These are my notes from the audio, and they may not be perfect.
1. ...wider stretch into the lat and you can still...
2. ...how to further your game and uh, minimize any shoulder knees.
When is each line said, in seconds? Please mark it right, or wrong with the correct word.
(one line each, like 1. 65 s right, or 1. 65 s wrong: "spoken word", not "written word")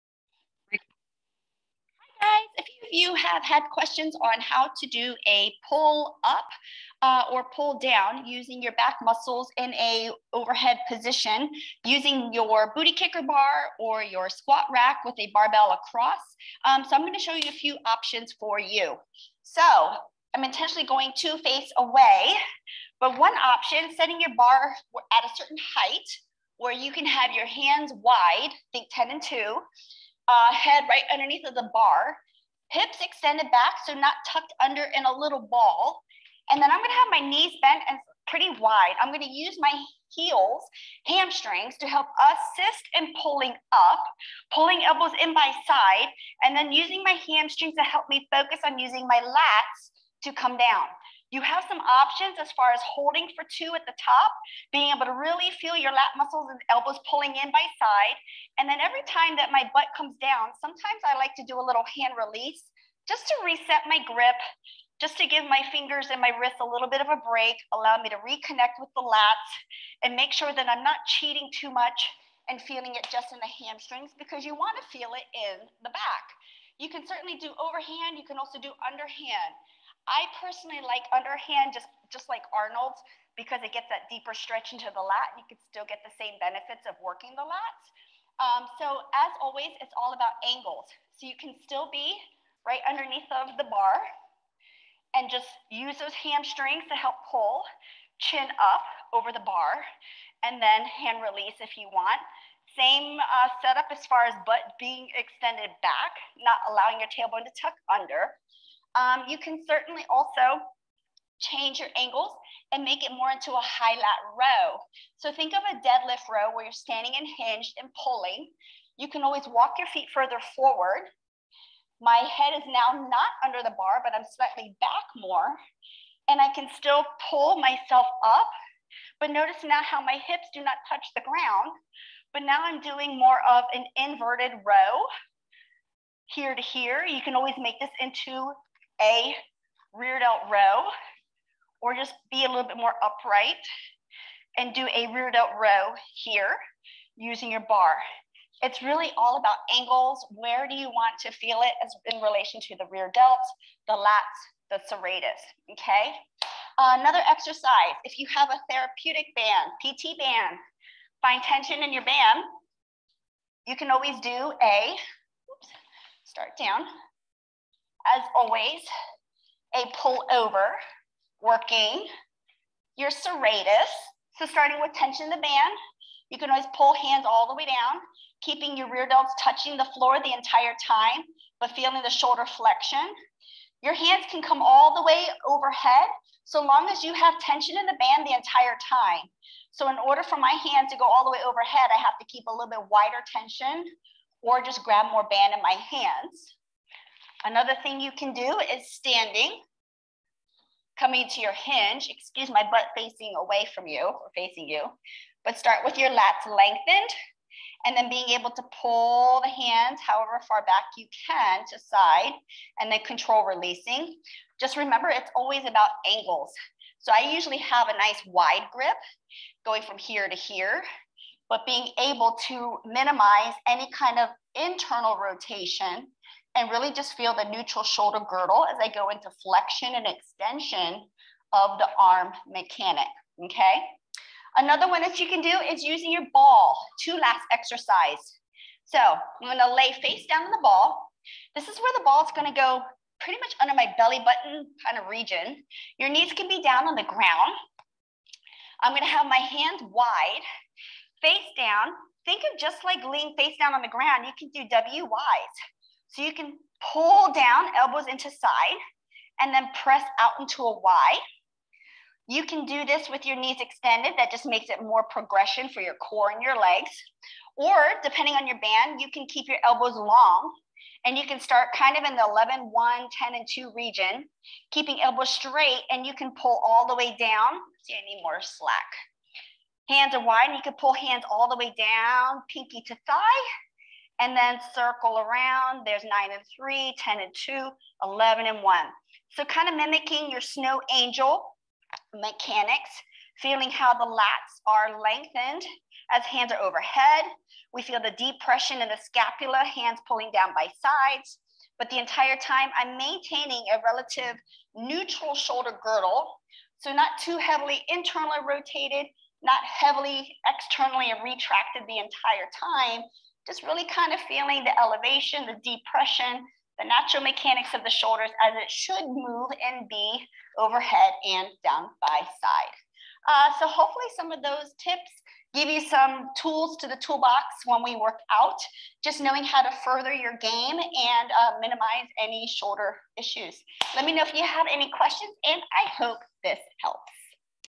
1. 84 s wrong: "deeper", not "wider"
2. 329 s wrong: "issues", not "knees".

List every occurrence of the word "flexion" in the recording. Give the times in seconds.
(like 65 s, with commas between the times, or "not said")
182 s, 229 s.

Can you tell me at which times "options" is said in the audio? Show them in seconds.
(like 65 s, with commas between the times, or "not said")
17 s, 23 s, 51 s.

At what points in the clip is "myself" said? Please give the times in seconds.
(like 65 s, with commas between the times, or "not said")
127 s.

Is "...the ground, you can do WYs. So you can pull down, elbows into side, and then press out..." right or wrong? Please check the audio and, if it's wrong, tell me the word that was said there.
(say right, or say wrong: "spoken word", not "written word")
right.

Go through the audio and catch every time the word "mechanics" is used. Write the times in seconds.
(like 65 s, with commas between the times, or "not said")
232 s, 292 s, 317 s.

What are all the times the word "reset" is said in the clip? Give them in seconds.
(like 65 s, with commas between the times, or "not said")
63 s.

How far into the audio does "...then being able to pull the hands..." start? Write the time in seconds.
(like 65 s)
207 s.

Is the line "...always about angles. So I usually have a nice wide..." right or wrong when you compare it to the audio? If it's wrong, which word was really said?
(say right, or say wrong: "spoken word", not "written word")
right.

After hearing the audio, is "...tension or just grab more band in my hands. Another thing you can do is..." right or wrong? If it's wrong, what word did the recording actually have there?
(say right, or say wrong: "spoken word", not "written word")
right.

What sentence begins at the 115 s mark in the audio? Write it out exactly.
So think of a deadlift row where you're standing and hinged and pulling.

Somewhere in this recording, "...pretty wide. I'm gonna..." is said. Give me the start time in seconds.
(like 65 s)
38 s.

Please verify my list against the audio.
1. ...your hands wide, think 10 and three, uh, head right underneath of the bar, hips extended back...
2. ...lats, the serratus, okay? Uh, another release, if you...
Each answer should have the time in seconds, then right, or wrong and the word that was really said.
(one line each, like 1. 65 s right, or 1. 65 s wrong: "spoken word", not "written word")
1. 27 s wrong: "two", not "three"
2. 153 s wrong: "exercise", not "release".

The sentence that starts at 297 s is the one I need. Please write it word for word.
We feel the depression in the scapula, hands pulling down by sides.